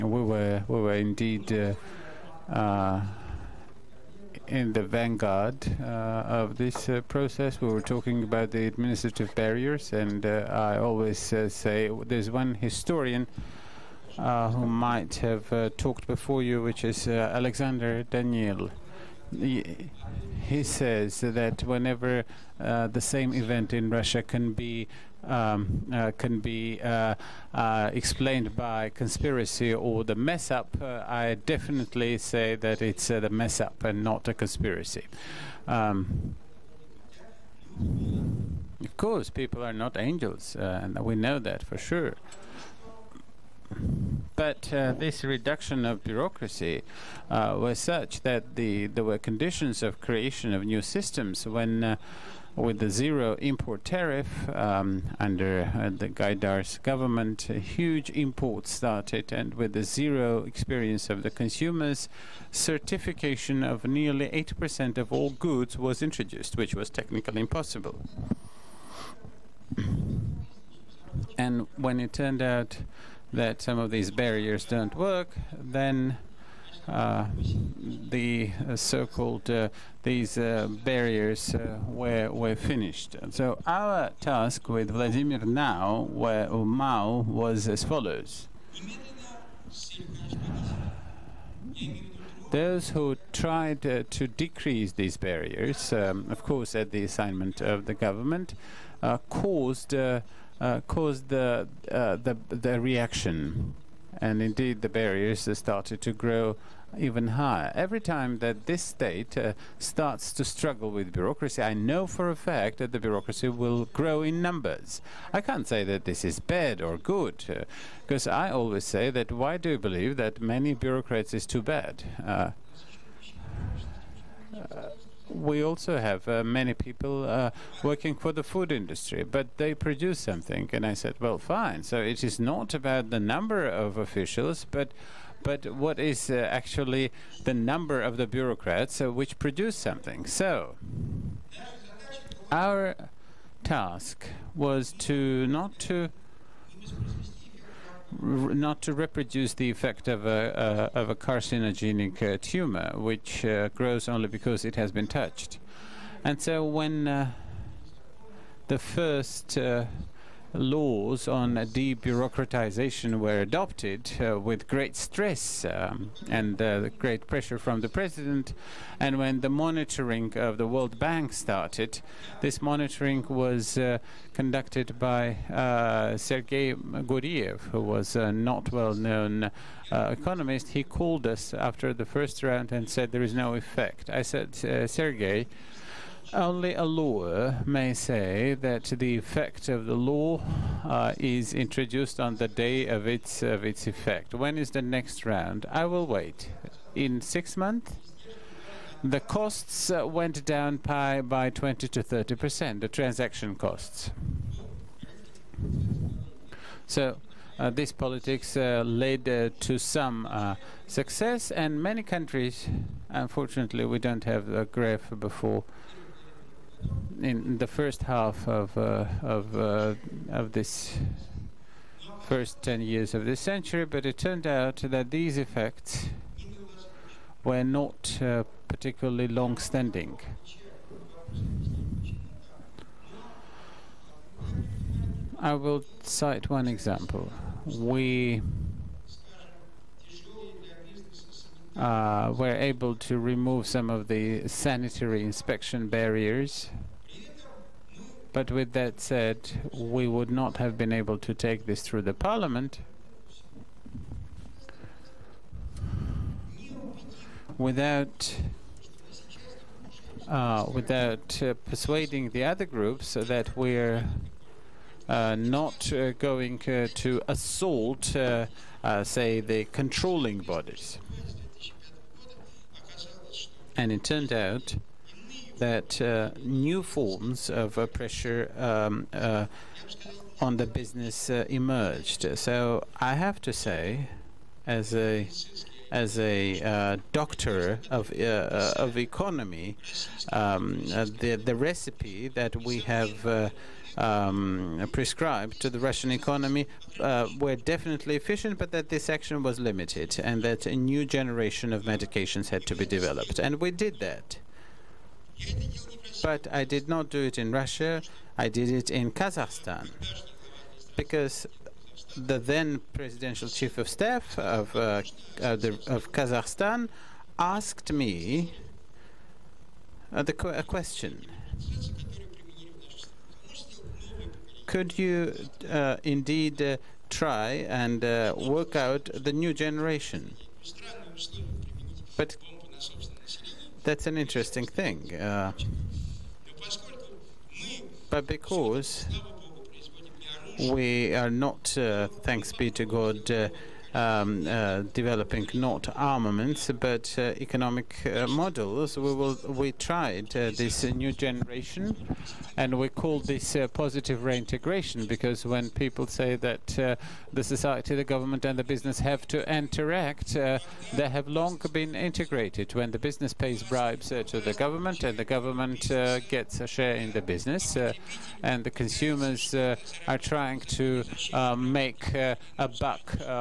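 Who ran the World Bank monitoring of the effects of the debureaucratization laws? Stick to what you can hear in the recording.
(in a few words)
Sergei Guriev.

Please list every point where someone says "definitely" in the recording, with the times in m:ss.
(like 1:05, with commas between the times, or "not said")
0:31, 4:57.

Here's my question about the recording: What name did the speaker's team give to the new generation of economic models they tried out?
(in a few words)
positive reintegration.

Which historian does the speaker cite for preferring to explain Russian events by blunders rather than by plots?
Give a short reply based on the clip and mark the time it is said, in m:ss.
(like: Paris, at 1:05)
Alexander Daniel, at 0:17.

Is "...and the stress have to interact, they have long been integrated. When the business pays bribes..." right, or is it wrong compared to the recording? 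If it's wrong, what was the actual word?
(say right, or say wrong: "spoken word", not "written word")
wrong: "business", not "stress".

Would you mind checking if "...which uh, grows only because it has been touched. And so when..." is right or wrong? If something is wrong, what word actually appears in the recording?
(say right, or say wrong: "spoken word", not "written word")
right.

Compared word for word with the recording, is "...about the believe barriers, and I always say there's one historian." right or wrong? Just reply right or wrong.
wrong.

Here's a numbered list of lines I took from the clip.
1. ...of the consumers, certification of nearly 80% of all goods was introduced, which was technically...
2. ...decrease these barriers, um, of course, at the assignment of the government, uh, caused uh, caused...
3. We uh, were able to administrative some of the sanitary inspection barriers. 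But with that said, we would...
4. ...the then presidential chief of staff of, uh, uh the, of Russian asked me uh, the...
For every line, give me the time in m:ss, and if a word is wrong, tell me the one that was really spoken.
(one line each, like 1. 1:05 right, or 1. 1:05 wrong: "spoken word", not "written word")
1. 1:01 right
2. 1:34 right
3. 3:57 wrong: "remove", not "administrative"
4. 5:12 wrong: "Kazakhstan", not "Russian".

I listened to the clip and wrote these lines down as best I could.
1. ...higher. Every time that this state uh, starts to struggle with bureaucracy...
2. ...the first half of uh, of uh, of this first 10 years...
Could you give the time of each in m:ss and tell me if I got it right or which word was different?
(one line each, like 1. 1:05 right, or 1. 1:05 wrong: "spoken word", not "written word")
1. 1:47 right
2. 3:37 right.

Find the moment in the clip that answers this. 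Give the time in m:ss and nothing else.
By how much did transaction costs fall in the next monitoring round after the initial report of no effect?
3:21.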